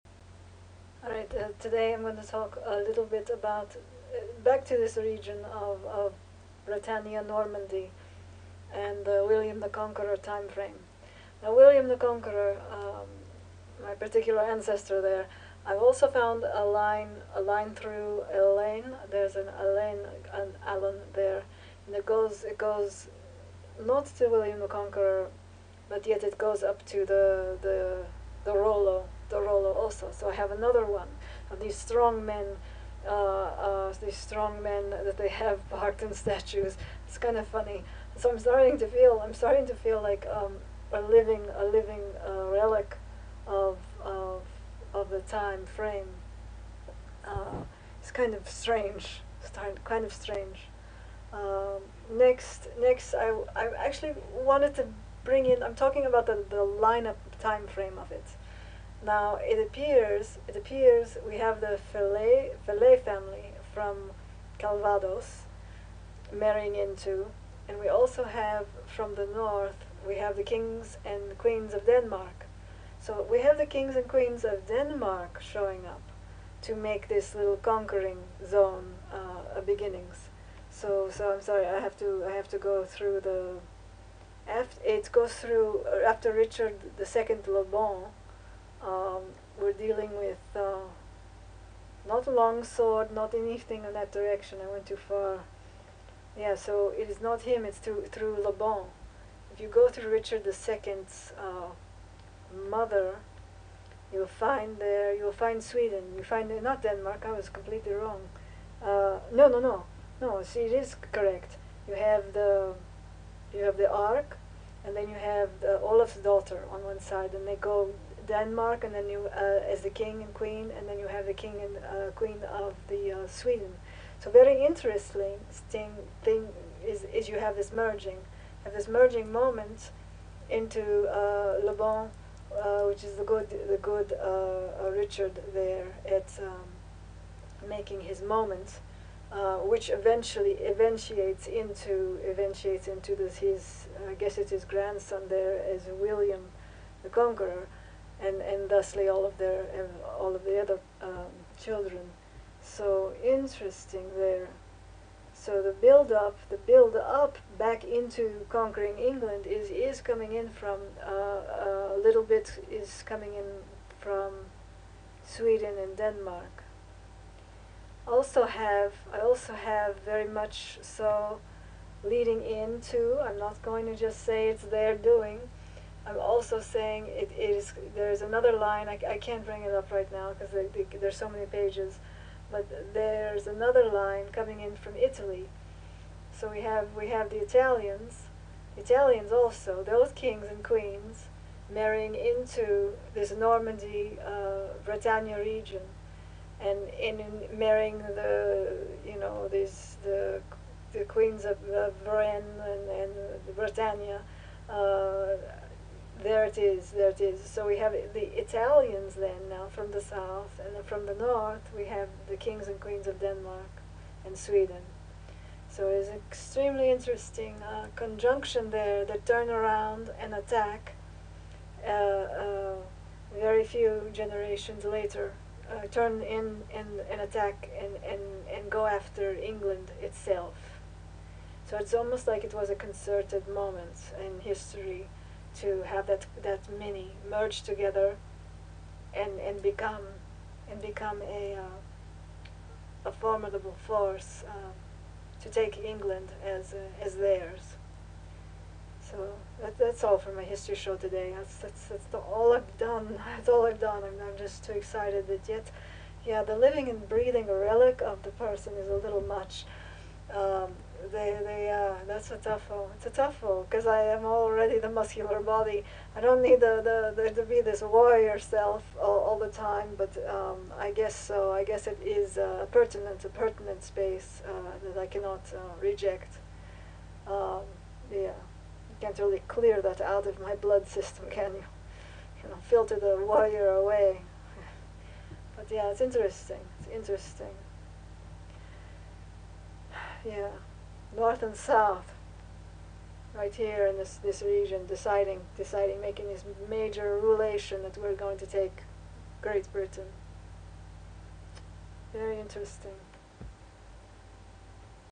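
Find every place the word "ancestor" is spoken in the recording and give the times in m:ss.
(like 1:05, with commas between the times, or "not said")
0:14.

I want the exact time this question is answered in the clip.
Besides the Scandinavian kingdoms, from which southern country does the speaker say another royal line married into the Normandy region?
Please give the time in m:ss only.
3:04.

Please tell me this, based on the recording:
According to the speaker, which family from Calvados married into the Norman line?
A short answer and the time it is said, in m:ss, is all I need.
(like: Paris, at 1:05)
Fillet, at 1:01.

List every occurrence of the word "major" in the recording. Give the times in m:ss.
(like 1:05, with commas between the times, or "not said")
4:56.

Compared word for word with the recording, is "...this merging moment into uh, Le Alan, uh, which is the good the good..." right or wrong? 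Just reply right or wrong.
wrong.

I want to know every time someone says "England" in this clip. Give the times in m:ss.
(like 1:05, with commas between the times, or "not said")
2:38, 3:49, 4:05.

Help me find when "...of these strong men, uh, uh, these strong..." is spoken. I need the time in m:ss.
0:31.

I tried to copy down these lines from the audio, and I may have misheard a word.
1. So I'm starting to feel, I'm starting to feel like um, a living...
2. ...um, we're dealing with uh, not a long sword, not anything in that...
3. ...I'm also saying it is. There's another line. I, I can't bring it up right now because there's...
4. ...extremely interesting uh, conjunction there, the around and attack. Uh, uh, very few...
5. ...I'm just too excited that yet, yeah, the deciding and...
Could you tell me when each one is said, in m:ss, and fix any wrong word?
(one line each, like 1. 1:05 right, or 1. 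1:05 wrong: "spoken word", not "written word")
1. 0:38 right
2. 1:28 right
3. 2:56 right
4. 3:36 right
5. 4:14 wrong: "living", not "deciding".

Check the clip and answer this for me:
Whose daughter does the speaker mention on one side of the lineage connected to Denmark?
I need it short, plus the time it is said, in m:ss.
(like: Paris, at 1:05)
Olaf, at 1:55.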